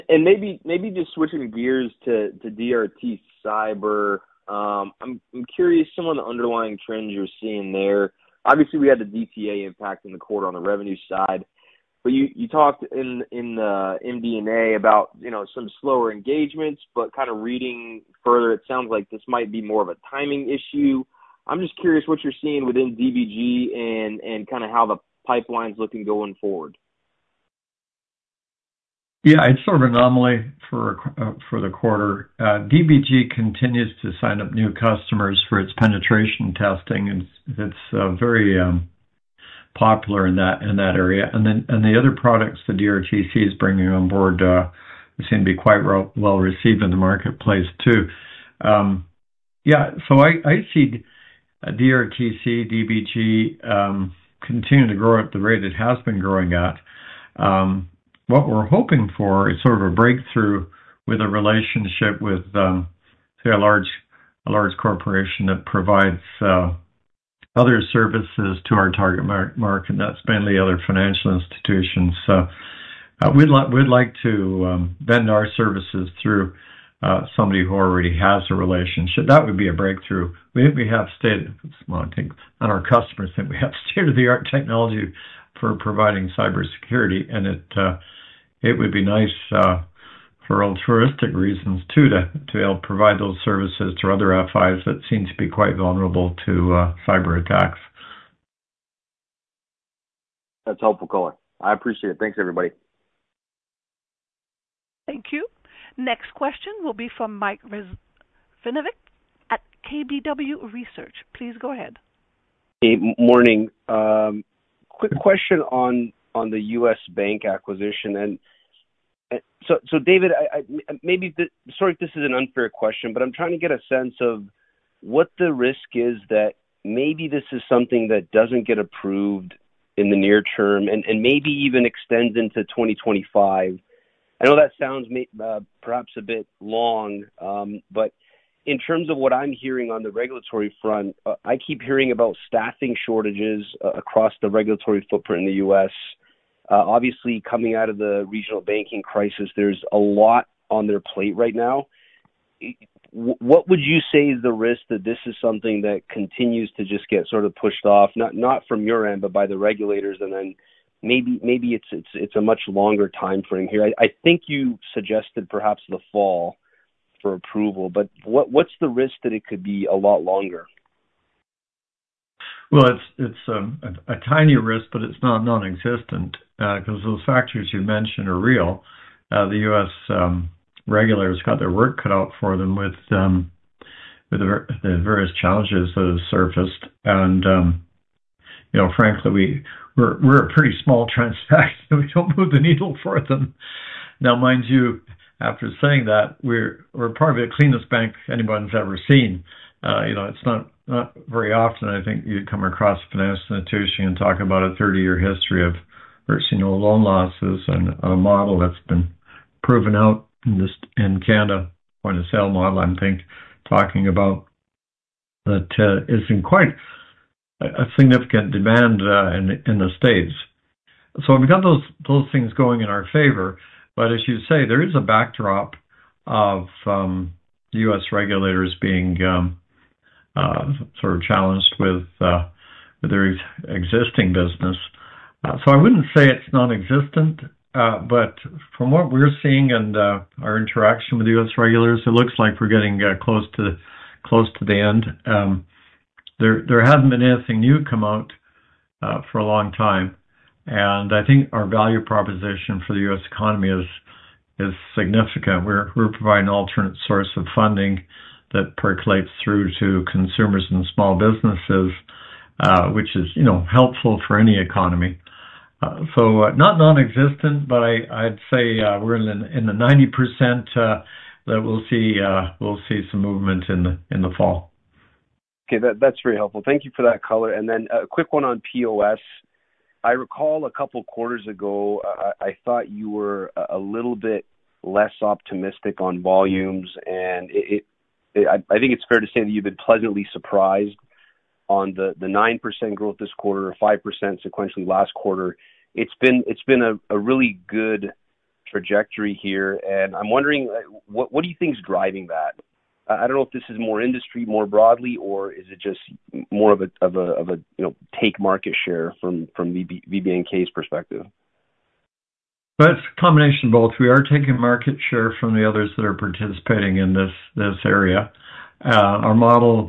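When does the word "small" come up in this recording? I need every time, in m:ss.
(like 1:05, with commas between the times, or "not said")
3:10, 4:20.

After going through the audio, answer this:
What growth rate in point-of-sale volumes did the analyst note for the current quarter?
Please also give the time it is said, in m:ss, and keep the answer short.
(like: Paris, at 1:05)
9%, at 4:52.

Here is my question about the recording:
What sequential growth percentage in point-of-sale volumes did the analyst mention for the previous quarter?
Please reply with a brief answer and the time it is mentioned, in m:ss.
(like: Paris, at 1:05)
5%, at 4:53.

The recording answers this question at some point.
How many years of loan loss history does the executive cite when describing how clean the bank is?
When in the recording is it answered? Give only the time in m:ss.
3:24.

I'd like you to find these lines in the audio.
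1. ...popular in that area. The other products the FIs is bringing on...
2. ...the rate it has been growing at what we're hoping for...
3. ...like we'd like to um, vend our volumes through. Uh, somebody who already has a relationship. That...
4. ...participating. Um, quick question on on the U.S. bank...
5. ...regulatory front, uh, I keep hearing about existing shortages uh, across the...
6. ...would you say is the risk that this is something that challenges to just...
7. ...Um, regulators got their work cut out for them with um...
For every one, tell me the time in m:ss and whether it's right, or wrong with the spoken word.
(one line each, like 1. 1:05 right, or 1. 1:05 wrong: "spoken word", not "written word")
1. 0:39 wrong: "DRTC", not "FIs"
2. 0:55 right
3. 1:13 wrong: "services", not "volumes"
4. 1:53 wrong: "morning", not "participating"
5. 2:20 wrong: "staffing", not "existing"
6. 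2:33 wrong: "continues", not "challenges"
7. 3:00 right.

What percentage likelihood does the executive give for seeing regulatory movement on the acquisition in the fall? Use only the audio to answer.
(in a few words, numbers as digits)
90%.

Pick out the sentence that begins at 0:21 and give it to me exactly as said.
I'm just curious what you're seeing within DBG and and kind of how the pipeline's looking going forward.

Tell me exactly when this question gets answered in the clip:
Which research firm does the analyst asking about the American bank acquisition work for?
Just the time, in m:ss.
1:49.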